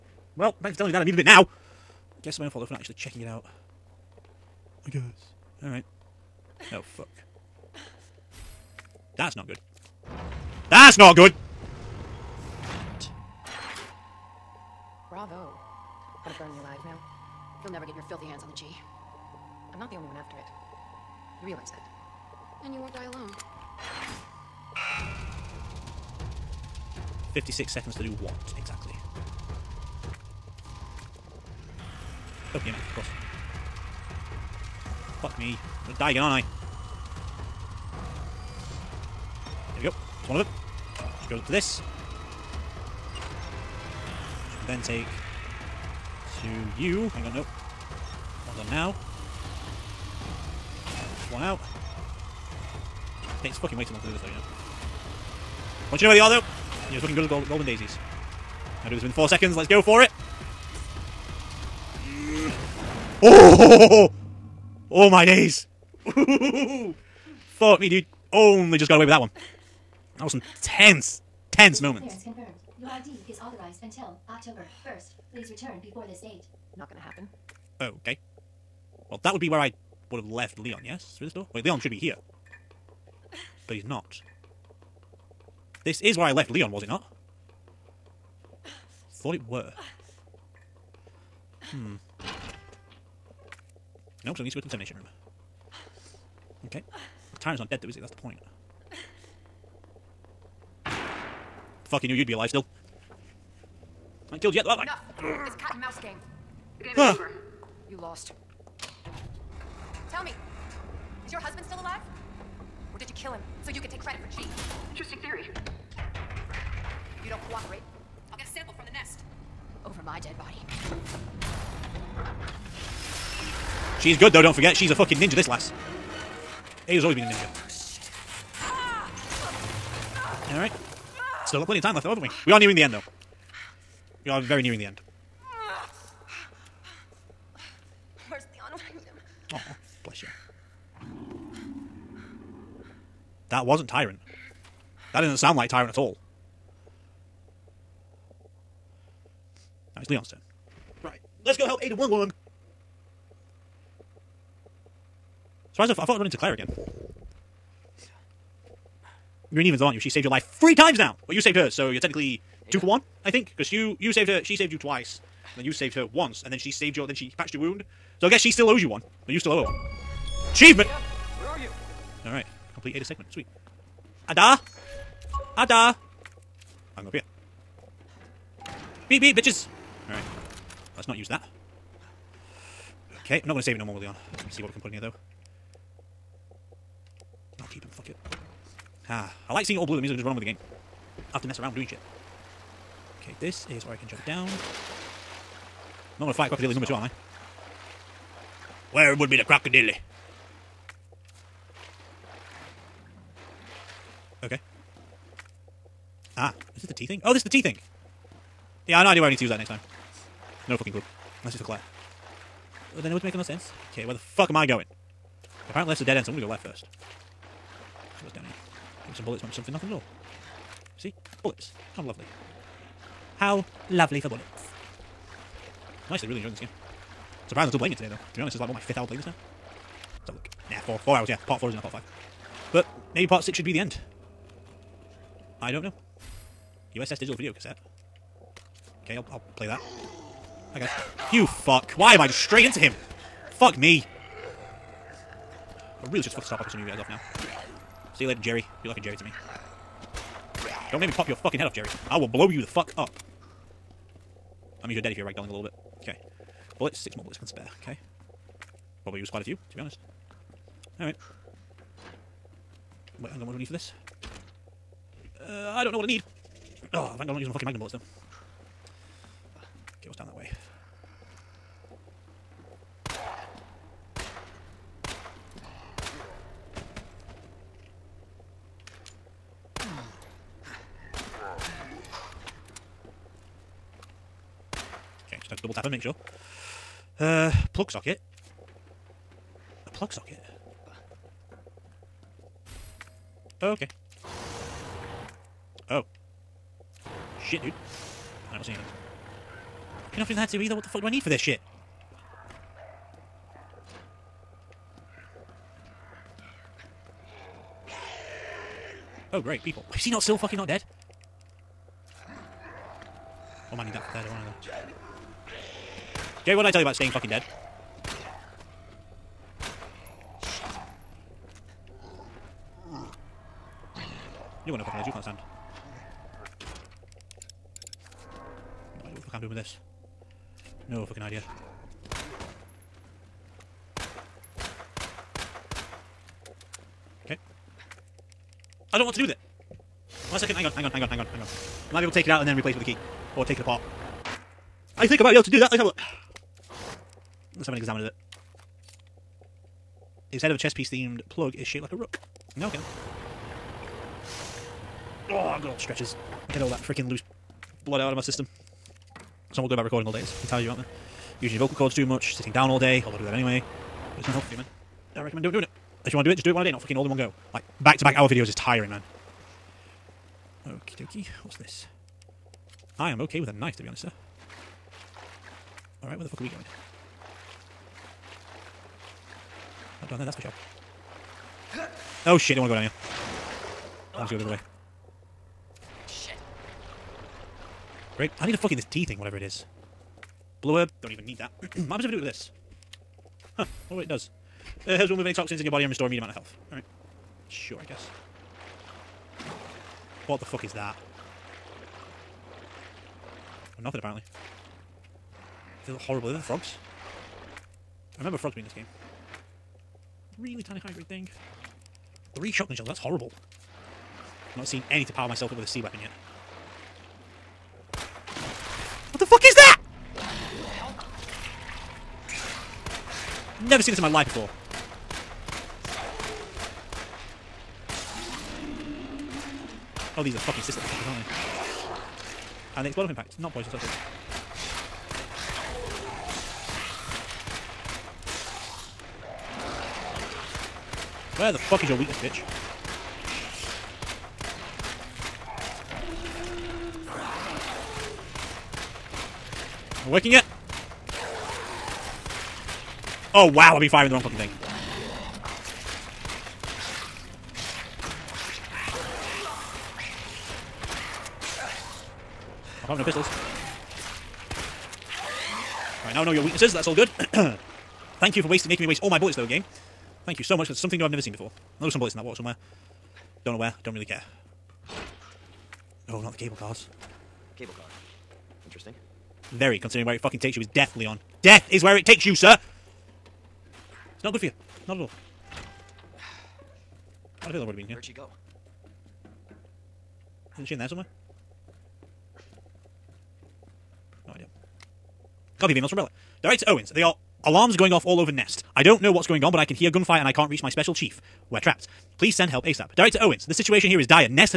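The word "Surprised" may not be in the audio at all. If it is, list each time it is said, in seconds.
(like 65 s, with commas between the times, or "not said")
155 s, 227 s.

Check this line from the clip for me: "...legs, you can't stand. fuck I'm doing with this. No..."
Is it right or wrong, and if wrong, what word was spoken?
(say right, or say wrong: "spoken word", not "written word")
right.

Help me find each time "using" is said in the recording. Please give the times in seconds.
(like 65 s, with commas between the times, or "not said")
267 s, 361 s.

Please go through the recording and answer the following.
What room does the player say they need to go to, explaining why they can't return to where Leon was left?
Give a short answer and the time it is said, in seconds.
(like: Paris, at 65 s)
termination room, at 94 s.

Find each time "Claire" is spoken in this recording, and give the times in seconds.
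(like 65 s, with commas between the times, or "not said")
156 s, 211 s.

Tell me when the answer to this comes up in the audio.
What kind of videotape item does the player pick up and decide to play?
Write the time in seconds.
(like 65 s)
236 s.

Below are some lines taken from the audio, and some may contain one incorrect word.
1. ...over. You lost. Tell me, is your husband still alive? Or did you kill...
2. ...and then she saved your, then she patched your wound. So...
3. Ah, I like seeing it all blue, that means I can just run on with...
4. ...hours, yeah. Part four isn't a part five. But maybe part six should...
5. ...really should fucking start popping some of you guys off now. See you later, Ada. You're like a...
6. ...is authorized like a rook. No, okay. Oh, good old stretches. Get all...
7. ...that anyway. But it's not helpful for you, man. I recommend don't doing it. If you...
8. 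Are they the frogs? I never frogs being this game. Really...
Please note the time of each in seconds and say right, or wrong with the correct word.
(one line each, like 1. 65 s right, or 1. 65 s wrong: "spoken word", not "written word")
1. 106 s right
2. 166 s right
3. 189 s right
4. 231 s right
5. 246 s wrong: "Jerry", not "Ada"
6. 351 s wrong: "shaped", not "authorized"
7. 363 s right
8. 406 s wrong: "remember", not "never".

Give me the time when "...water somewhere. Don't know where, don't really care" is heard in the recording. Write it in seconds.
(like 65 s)
472 s.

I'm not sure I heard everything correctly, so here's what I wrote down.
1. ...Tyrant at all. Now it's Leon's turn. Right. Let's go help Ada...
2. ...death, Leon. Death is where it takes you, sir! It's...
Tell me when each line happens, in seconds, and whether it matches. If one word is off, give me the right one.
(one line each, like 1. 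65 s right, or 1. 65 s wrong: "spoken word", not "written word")
1. 145 s right
2. 480 s right.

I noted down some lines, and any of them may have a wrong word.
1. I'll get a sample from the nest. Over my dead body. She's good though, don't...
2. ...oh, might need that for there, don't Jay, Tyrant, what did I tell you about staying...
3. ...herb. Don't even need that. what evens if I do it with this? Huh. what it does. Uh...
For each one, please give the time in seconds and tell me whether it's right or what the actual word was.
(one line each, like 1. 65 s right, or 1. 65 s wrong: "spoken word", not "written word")
1. 118 s right
2. 313 s wrong: "Jerry", not "Tyrant"
3. 390 s wrong: "happens", not "evens".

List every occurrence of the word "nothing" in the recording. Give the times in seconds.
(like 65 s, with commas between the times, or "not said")
219 s, 403 s.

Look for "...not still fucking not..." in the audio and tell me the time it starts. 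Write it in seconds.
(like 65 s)
310 s.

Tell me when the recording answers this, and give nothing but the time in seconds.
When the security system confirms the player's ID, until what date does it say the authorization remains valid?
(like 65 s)
74 s.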